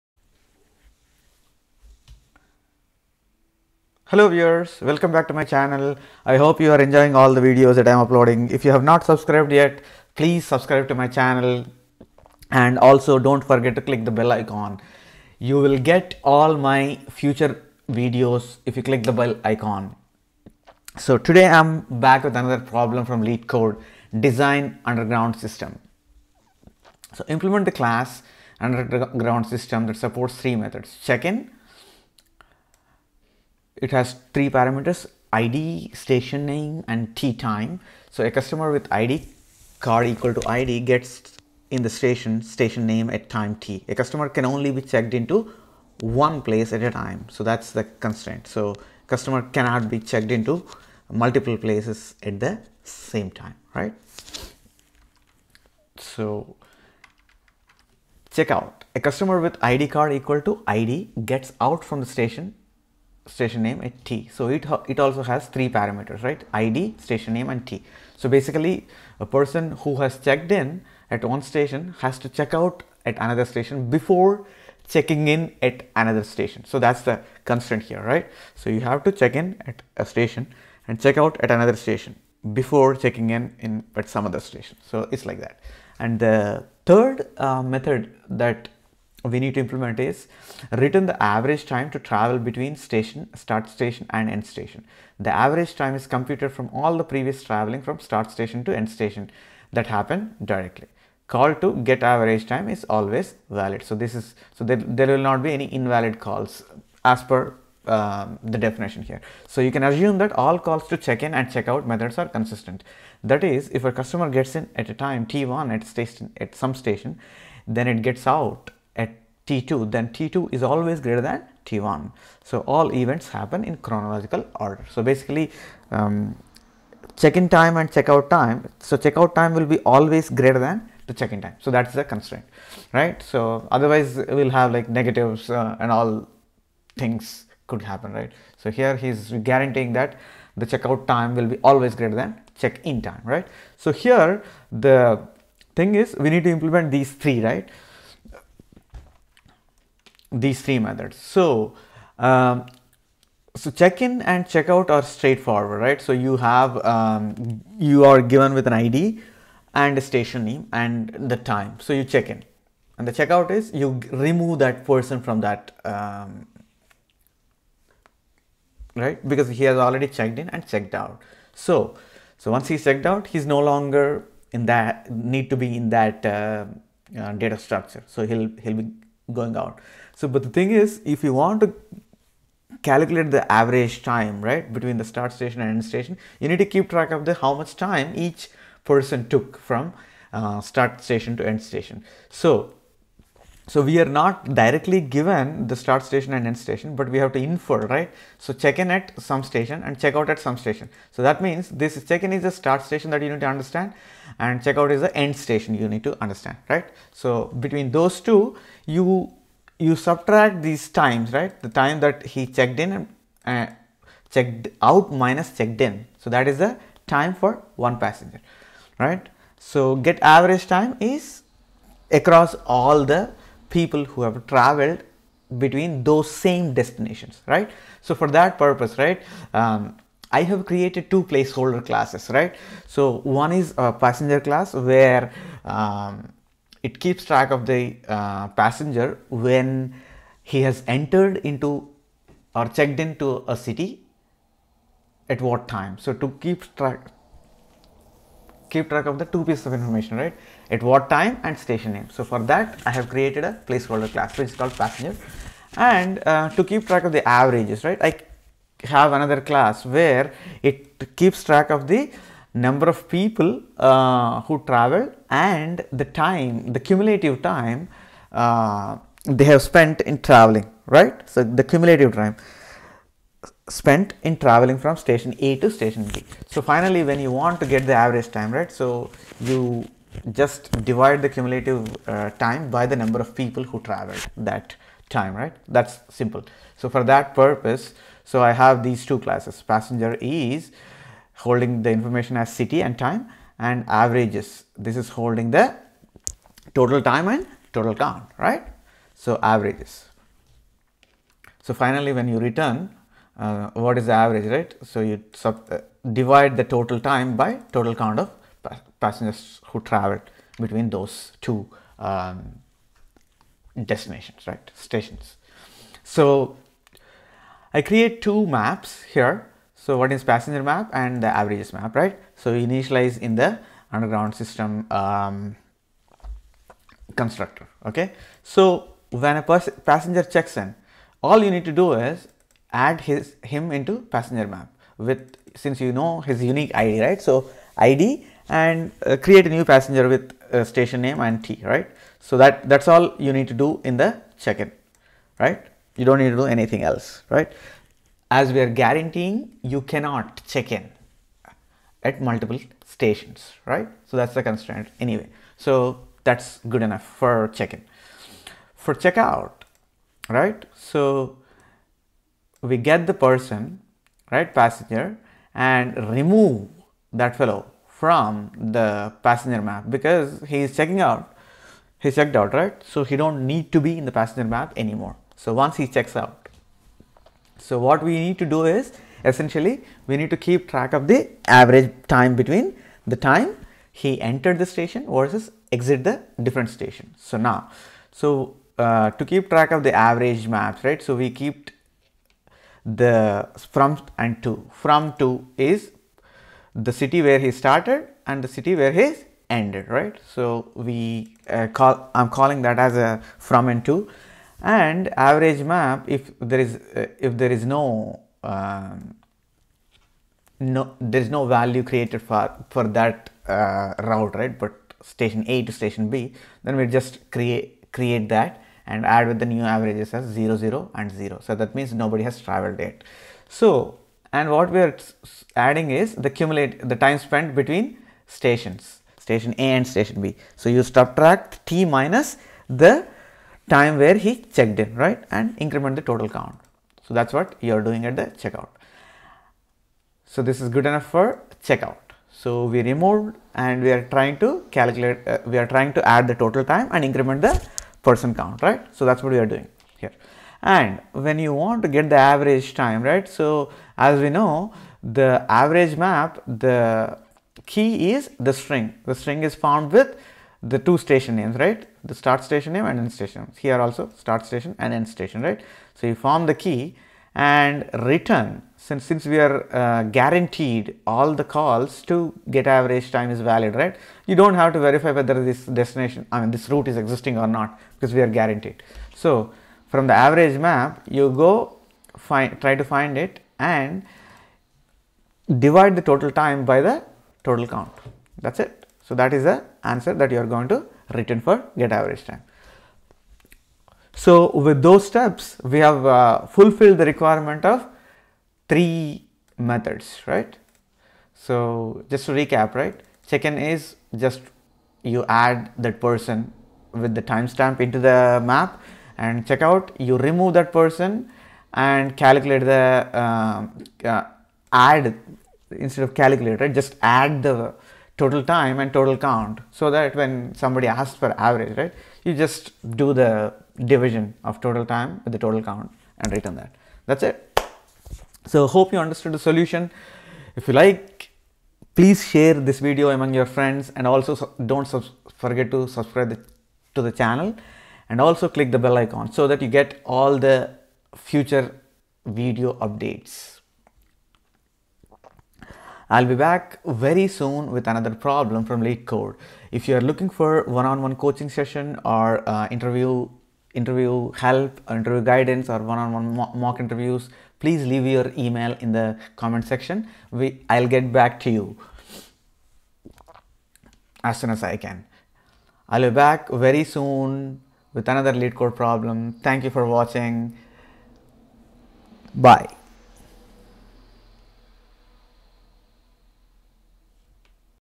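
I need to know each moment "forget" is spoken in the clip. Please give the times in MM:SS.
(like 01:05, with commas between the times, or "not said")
00:13, 08:55.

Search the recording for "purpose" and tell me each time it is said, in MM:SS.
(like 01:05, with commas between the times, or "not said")
03:48, 04:47.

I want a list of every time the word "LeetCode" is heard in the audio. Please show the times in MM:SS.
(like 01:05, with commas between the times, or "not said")
00:23, 09:08, 09:28.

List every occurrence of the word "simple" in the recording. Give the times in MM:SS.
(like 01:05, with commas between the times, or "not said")
04:46.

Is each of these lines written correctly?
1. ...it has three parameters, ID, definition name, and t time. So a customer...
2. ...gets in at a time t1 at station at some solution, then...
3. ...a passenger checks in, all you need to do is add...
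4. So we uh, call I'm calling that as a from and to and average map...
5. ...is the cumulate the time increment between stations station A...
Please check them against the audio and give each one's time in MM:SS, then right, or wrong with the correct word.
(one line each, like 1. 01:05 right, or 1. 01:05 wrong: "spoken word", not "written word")
1. 00:33 wrong: "station", not "definition"
2. 01:54 wrong: "station", not "solution"
3. 05:29 right
4. 06:40 right
5. 07:05 wrong: "spent", not "increment".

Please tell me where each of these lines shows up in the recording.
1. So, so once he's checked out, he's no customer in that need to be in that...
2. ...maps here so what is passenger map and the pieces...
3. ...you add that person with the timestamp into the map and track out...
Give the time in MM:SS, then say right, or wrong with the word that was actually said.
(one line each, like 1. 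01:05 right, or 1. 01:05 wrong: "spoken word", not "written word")
1. 02:51 wrong: "longer", not "customer"
2. 05:18 wrong: "averages", not "pieces"
3. 08:25 wrong: "check", not "track".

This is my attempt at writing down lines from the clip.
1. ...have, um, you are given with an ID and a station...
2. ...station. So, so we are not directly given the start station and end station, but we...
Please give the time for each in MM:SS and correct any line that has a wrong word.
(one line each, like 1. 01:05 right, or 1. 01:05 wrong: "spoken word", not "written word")
1. 02:36 right
2. 03:11 right.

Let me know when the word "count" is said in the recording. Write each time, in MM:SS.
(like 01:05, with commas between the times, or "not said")
04:57, 05:08, 07:16, 07:28, 08:07, 08:39, 08:45.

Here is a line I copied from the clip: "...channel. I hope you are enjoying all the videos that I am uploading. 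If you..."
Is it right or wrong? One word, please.
right.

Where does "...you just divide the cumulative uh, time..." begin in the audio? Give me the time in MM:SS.
04:39.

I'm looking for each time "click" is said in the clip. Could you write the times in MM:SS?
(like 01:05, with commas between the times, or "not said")
00:13, 00:18, 08:58.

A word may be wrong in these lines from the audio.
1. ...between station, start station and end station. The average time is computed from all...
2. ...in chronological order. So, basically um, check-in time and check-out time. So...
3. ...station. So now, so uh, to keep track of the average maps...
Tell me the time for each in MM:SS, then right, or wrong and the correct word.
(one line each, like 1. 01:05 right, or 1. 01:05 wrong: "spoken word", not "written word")
1. 01:32 right
2. 02:03 right
3. 06:26 right.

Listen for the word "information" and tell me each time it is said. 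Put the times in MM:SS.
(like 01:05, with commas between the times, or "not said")
04:09, 04:51.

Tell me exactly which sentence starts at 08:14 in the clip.
So with those steps, we have uh, fulfilled the requirement of three methods, right?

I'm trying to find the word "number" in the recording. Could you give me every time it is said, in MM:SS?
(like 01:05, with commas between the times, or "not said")
04:22, 04:42.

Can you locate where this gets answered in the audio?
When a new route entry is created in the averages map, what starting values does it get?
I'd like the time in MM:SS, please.
07:00.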